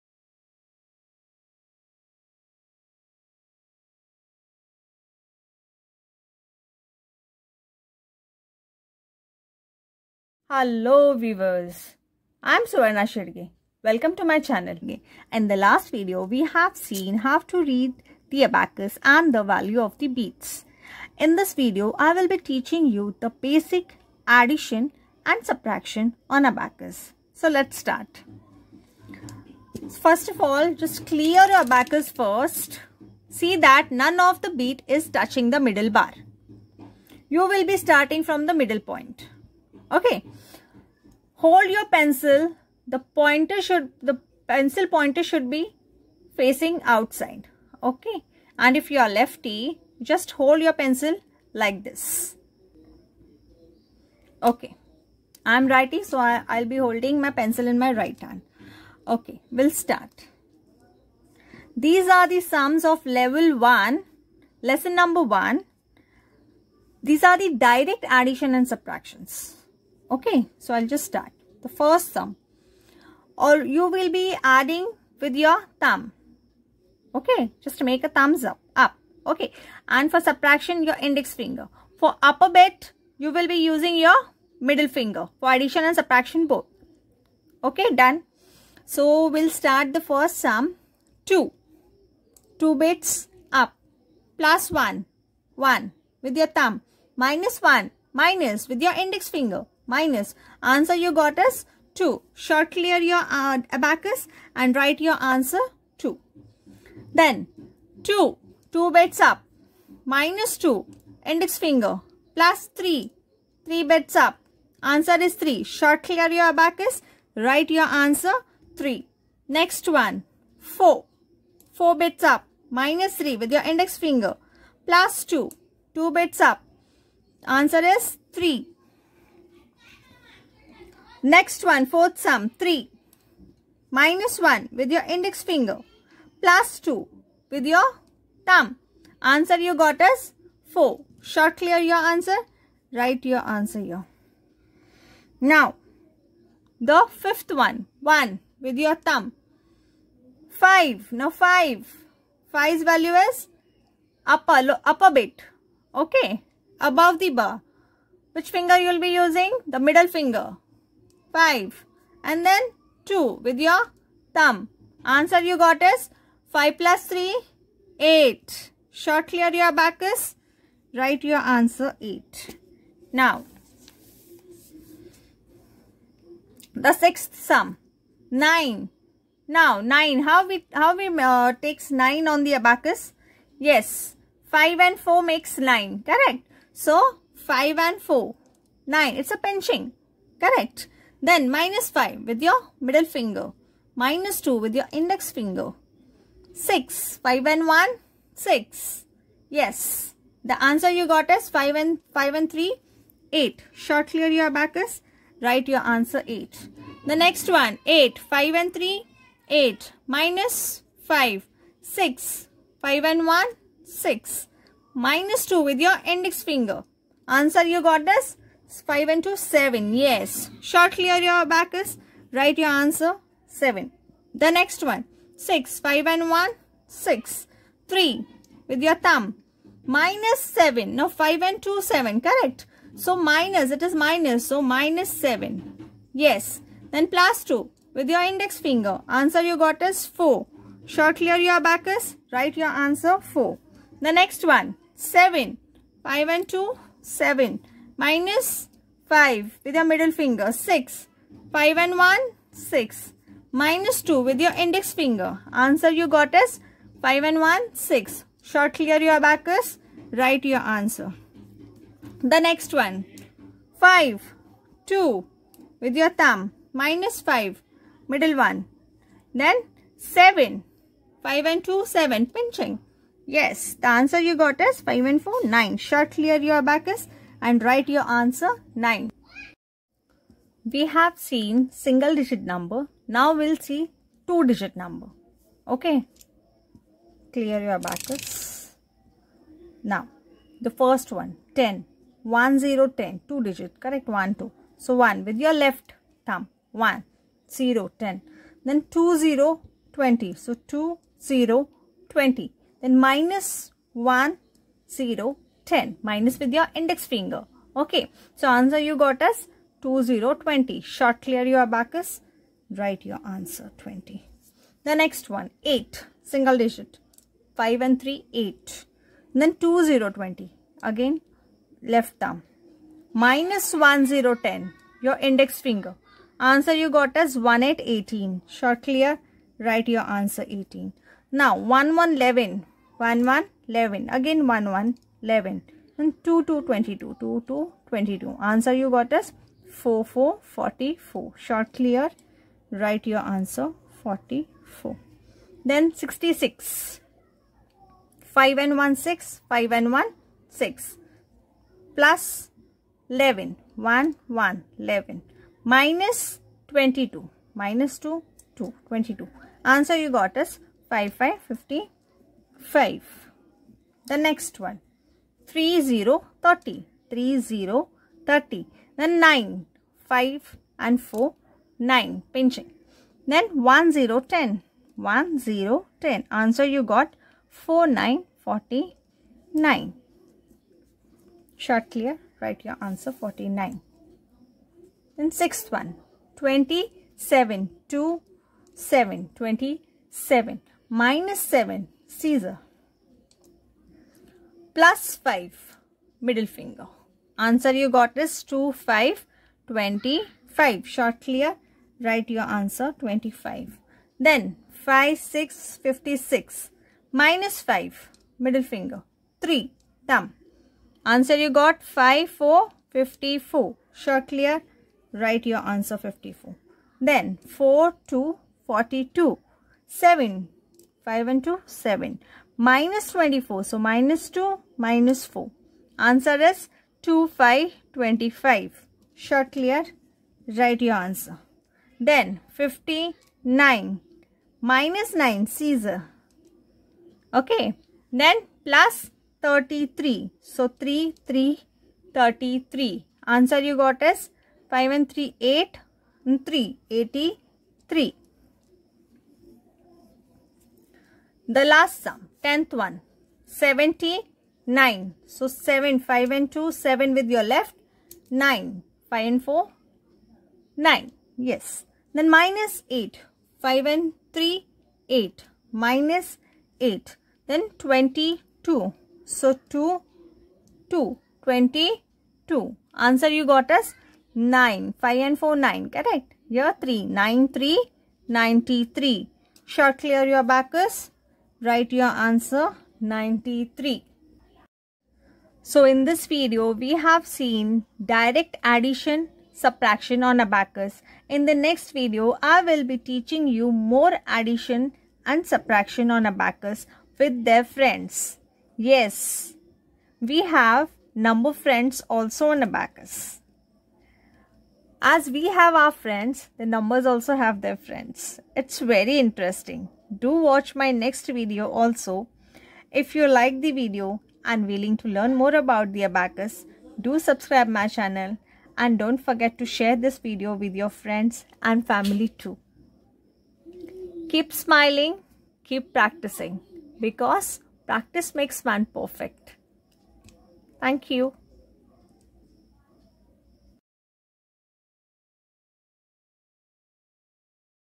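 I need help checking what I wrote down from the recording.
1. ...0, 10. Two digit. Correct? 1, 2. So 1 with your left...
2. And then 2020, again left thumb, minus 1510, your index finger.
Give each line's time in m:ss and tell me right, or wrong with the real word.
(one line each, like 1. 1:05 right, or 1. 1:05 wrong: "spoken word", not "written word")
1. 4:52 right
2. 5:19 wrong: "1010", not "1510".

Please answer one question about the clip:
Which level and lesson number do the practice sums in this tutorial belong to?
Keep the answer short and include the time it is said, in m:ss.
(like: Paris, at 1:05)
Level 1, lesson 1, at 1:03.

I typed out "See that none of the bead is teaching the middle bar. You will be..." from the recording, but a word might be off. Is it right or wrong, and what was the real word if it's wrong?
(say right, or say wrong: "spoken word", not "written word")
wrong: "touching", not "teaching".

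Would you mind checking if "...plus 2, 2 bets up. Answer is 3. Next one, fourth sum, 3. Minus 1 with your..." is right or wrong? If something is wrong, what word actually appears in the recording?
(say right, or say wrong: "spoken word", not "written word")
right.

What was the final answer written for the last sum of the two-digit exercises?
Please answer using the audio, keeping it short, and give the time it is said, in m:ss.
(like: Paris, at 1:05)
93, at 8:03.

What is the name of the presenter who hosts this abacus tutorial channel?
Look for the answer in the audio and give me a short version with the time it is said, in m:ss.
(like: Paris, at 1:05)
Suvarna Shedge, at 0:12.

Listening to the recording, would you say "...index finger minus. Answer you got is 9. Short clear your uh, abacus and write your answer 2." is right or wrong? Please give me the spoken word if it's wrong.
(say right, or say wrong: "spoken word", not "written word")
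wrong: "2", not "9".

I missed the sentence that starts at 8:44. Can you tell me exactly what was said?
Keep smiling, keep practicing because practice makes man perfect.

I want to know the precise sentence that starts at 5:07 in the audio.
Okay, so answer you got us 2020.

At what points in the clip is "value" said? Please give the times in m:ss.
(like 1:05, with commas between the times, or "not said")
0:19, 2:32.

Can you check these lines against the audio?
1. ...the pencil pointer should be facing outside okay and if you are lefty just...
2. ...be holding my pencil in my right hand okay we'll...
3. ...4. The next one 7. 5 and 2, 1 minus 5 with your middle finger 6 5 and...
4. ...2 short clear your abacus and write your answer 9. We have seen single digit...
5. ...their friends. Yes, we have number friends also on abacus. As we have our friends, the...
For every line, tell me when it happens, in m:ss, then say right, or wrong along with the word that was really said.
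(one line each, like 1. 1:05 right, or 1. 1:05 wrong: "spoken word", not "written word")
1. 0:44 right
2. 0:56 right
3. 4:03 wrong: "7", not "1"
4. 4:35 wrong: "9", not "2"
5. 8:17 right.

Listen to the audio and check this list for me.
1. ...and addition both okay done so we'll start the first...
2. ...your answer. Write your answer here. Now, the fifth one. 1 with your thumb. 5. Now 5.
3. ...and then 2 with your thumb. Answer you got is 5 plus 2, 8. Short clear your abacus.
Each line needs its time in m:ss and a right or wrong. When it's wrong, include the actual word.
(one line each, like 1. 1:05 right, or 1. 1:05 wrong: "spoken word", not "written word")
1. 1:25 wrong: "subtraction", not "addition"
2. 2:21 right
3. 2:42 wrong: "3", not "2".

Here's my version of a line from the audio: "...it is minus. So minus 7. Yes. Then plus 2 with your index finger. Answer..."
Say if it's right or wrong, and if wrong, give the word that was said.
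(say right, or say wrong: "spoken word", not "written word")
right.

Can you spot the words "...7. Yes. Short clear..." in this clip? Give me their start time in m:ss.
3:39.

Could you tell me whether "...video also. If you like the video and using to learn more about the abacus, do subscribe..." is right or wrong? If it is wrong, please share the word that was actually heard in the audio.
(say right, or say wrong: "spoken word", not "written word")
wrong: "willing", not "using".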